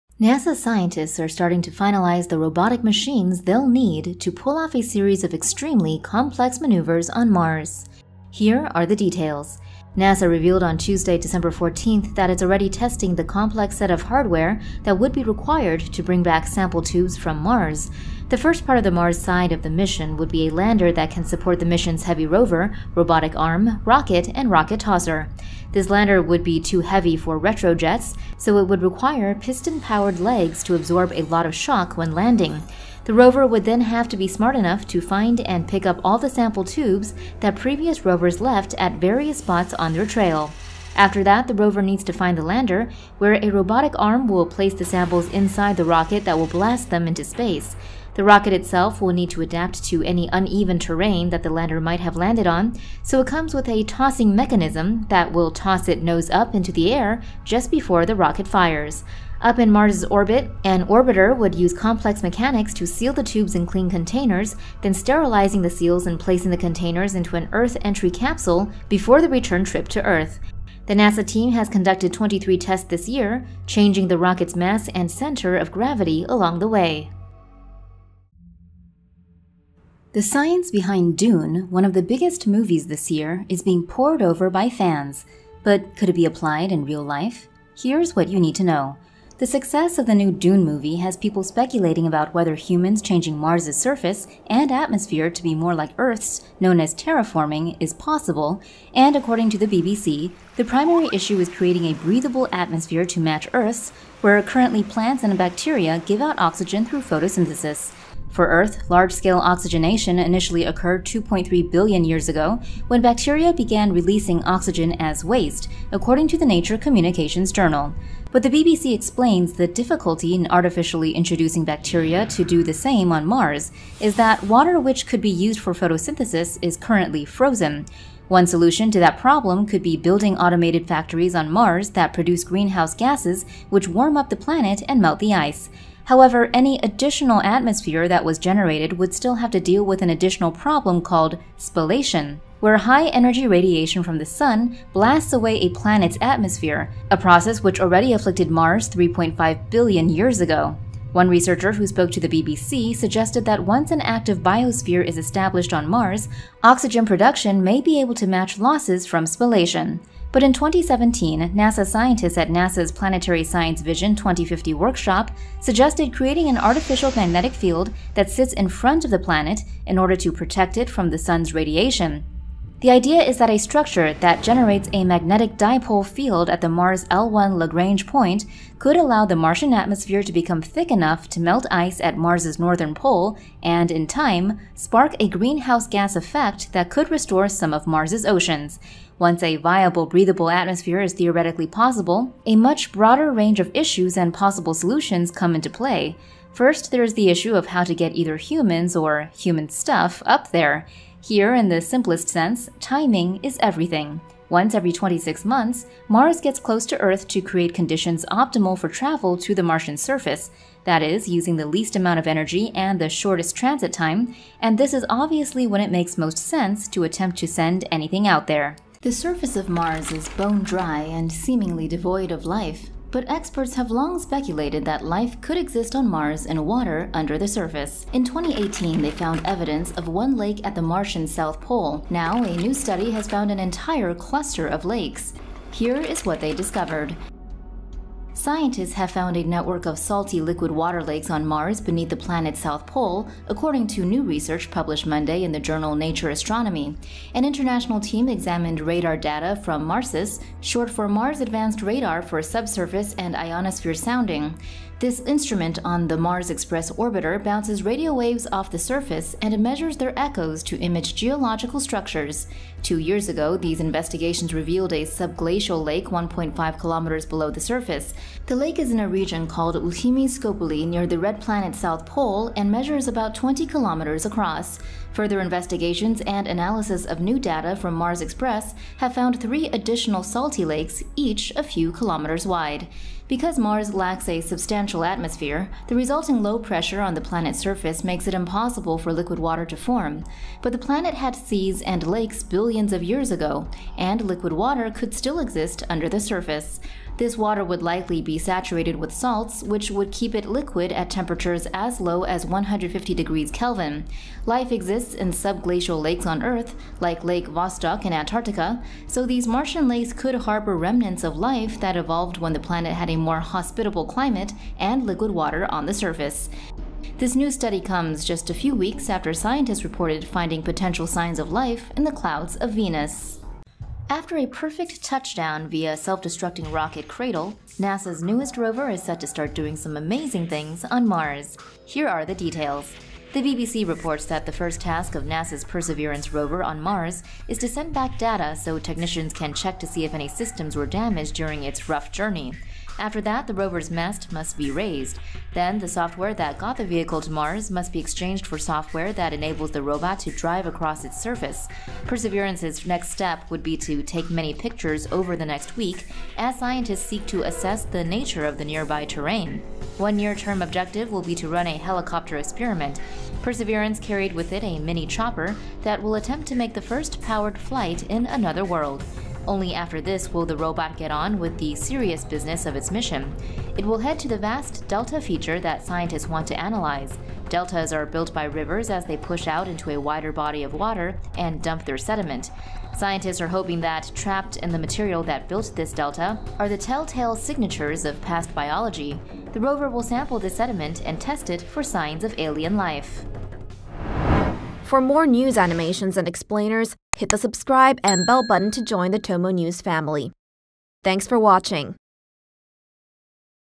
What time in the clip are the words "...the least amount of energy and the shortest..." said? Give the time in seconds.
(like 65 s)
211 s.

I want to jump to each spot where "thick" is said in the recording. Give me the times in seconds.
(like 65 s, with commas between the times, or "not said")
180 s.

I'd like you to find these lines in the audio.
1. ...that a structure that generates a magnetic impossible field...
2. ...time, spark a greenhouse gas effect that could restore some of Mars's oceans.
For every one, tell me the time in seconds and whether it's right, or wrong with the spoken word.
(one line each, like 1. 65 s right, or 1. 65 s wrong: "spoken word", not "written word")
1. 173 s wrong: "dipole", not "impossible"
2. 184 s right.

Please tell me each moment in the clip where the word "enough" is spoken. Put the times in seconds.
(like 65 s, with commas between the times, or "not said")
34 s, 180 s.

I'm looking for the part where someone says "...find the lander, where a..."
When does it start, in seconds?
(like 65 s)
42 s.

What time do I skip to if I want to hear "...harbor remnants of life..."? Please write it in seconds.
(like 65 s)
310 s.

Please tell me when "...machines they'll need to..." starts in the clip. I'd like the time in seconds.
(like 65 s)
2 s.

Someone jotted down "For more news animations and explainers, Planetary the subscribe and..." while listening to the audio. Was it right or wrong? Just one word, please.
wrong.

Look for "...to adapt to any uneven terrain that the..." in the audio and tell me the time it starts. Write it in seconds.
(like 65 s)
49 s.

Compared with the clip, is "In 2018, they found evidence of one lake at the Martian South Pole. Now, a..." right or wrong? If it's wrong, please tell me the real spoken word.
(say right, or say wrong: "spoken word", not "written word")
right.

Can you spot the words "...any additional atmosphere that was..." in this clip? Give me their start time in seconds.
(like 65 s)
136 s.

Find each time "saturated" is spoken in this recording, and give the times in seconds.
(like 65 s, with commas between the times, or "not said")
298 s.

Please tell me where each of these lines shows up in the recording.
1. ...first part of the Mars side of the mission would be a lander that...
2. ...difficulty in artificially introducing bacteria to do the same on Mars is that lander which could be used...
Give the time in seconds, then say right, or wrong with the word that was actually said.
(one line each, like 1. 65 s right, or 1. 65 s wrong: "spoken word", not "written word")
1. 18 s right
2. 119 s wrong: "water", not "lander".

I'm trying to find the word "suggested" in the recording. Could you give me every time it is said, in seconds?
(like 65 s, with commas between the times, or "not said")
152 s, 165 s.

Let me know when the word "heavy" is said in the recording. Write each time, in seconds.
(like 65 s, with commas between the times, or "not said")
22 s, 26 s.